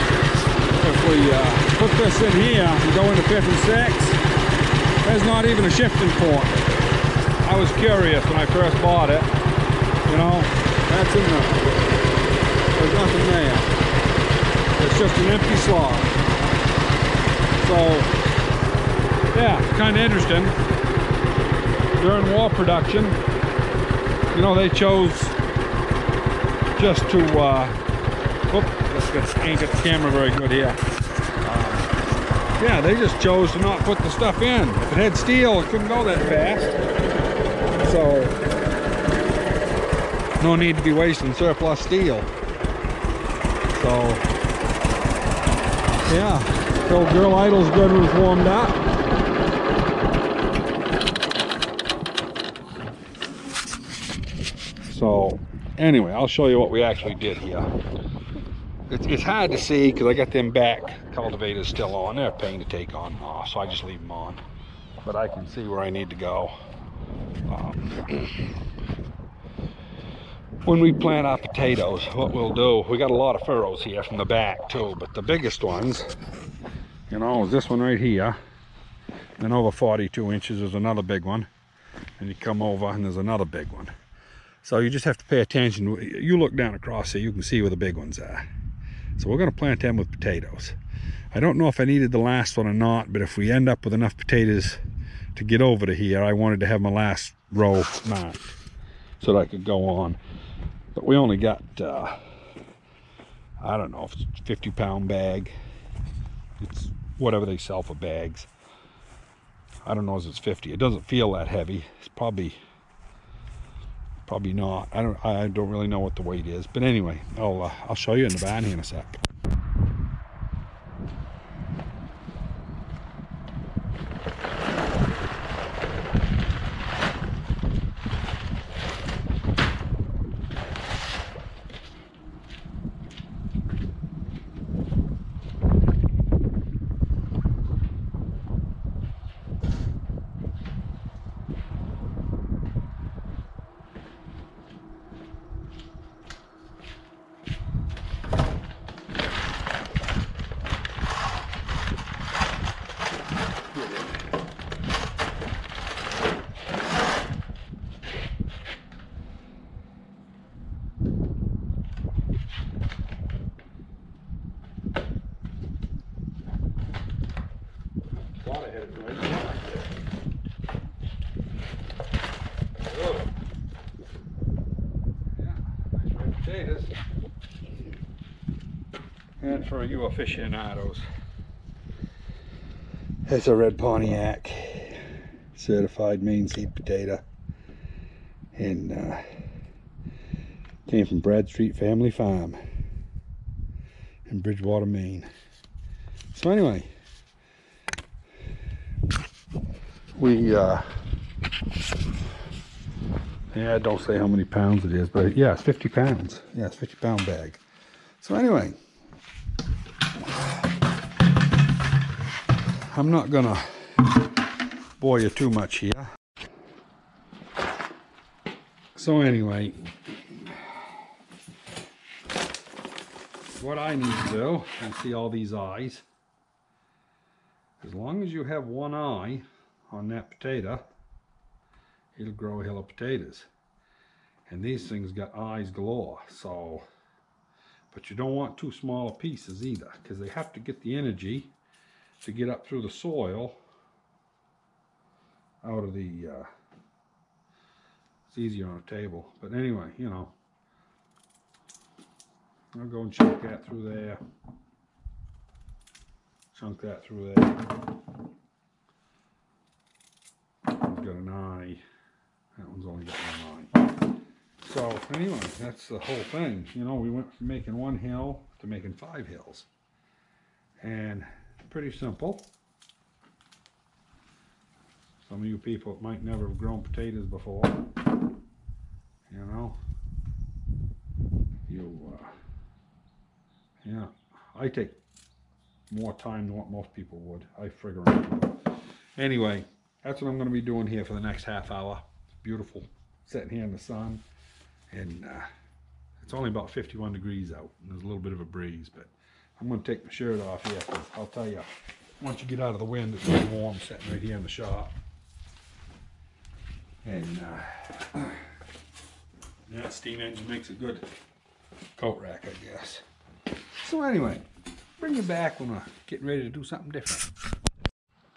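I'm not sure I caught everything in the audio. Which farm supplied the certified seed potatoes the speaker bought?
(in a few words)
Bradstreet Family Farm.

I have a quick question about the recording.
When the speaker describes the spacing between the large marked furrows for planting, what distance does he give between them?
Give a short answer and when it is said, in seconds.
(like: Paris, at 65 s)
42 inches, at 79 s.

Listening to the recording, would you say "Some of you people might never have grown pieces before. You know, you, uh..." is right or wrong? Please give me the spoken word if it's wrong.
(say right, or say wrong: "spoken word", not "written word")
wrong: "potatoes", not "pieces".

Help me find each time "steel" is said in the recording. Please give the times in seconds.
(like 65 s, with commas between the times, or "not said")
35 s, 41 s.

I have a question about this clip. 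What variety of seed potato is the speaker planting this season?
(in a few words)
Red Pontiac.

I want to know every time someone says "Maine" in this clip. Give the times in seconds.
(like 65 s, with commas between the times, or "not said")
186 s, 194 s.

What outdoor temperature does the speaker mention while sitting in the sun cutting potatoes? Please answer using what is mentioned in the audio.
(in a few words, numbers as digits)
51 degrees.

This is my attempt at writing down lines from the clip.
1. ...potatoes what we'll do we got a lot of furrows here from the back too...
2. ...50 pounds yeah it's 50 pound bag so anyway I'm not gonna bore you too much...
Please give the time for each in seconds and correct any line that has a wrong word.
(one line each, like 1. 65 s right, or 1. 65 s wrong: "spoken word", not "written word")
1. 71 s right
2. 205 s right.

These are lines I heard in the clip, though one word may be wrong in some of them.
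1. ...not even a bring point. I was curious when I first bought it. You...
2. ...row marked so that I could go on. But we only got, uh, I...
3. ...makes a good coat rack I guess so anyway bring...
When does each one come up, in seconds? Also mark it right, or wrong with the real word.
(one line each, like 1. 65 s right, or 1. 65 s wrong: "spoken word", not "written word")
1. 5 s wrong: "shifting", not "bring"
2. 97 s right
3. 310 s right.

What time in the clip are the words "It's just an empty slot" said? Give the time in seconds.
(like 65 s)
14 s.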